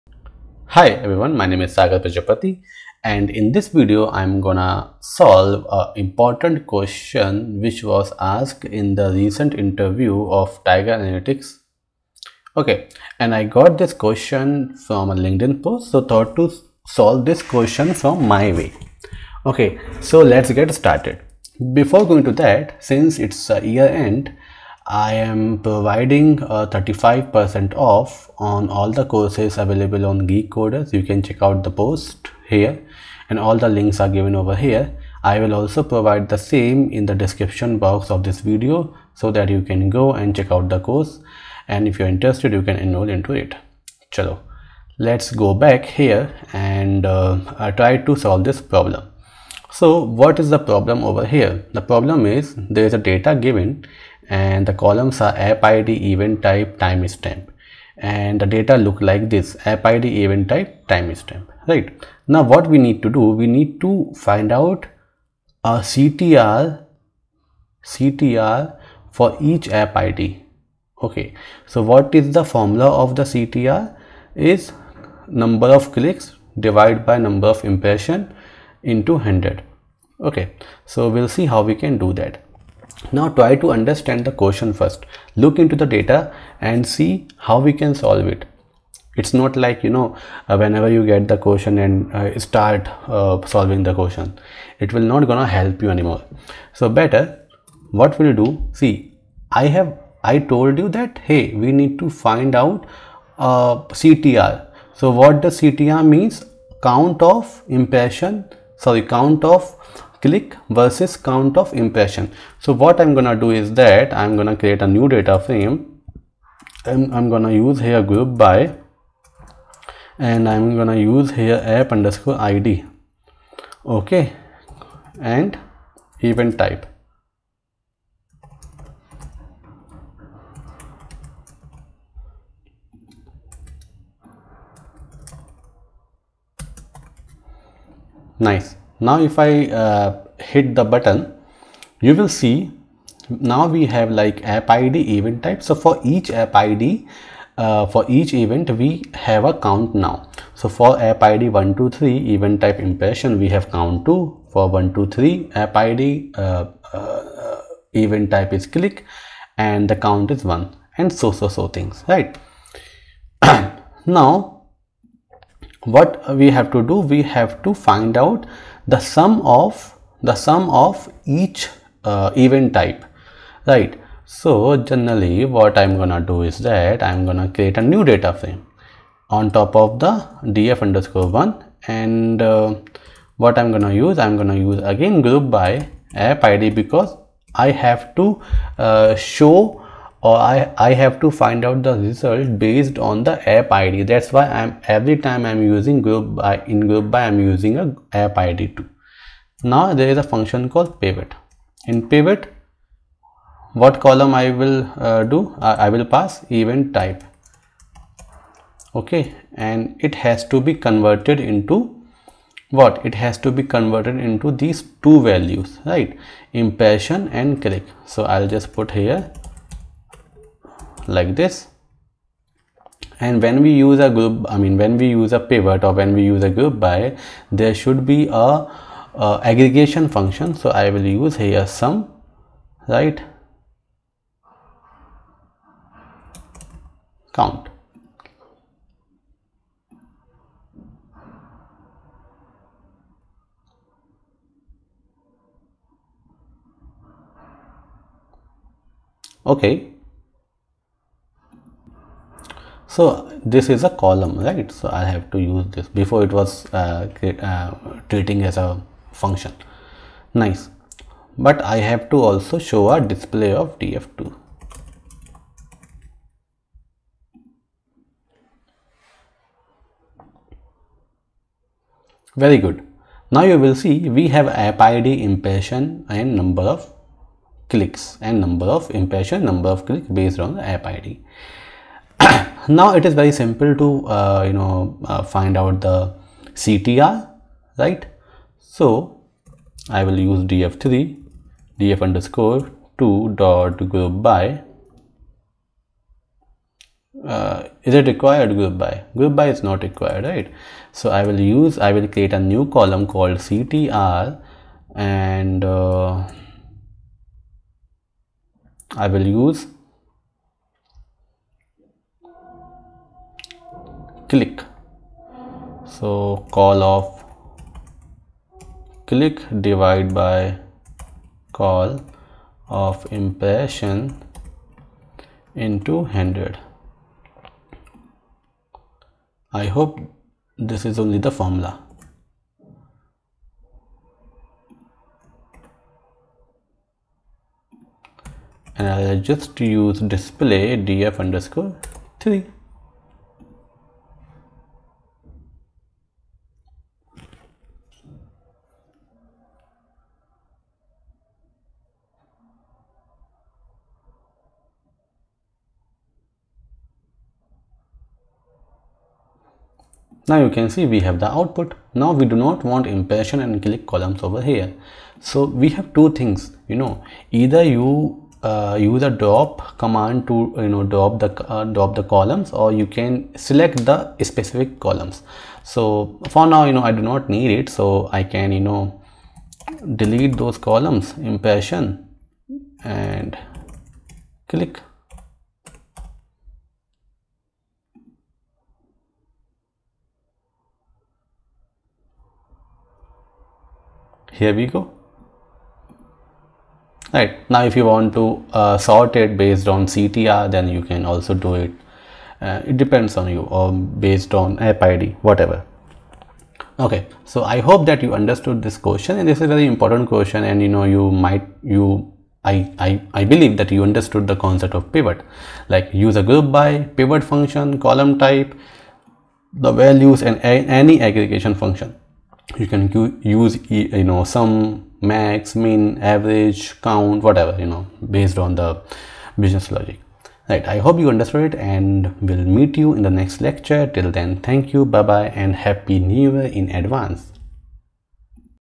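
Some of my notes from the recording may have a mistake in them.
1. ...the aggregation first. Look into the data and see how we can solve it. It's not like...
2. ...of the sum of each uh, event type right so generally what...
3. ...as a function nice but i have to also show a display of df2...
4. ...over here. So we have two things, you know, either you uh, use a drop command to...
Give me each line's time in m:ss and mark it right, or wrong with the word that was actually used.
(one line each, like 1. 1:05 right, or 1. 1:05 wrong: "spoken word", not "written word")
1. 1:24 wrong: "question", not "aggregation"
2. 2:49 right
3. 4:18 right
4. 6:04 right.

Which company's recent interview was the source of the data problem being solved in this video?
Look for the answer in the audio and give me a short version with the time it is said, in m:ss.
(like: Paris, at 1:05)
Tiger Analytics, at 0:10.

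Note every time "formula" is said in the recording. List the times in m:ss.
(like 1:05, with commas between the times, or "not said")
1:12, 5:31.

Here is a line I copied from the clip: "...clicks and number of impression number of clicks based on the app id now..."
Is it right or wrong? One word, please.
right.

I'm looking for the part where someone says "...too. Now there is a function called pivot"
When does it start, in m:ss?
3:18.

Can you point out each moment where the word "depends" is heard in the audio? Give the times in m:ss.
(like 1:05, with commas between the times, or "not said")
6:42.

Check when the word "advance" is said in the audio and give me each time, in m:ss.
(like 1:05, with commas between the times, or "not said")
7:16.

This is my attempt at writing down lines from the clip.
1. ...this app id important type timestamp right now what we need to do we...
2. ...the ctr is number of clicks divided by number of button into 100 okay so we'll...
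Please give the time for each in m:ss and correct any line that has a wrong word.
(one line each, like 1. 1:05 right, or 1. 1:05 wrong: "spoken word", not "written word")
1. 0:59 wrong: "event", not "important"
2. 1:13 wrong: "impression", not "button".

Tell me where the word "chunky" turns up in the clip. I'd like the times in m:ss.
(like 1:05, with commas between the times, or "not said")
not said.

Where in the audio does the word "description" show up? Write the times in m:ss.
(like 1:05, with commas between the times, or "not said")
0:37.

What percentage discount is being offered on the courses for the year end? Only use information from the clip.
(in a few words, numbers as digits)
35%.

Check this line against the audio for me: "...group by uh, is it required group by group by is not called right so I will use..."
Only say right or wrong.
wrong.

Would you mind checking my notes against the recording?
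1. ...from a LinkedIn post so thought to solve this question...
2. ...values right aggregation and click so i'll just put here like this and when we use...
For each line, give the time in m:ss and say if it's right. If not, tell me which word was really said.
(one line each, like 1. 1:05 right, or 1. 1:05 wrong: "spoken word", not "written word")
1. 0:14 right
2. 3:35 wrong: "impression", not "aggregation".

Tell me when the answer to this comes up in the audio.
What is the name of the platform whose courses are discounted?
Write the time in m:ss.
0:30.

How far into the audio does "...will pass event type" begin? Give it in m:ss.
3:25.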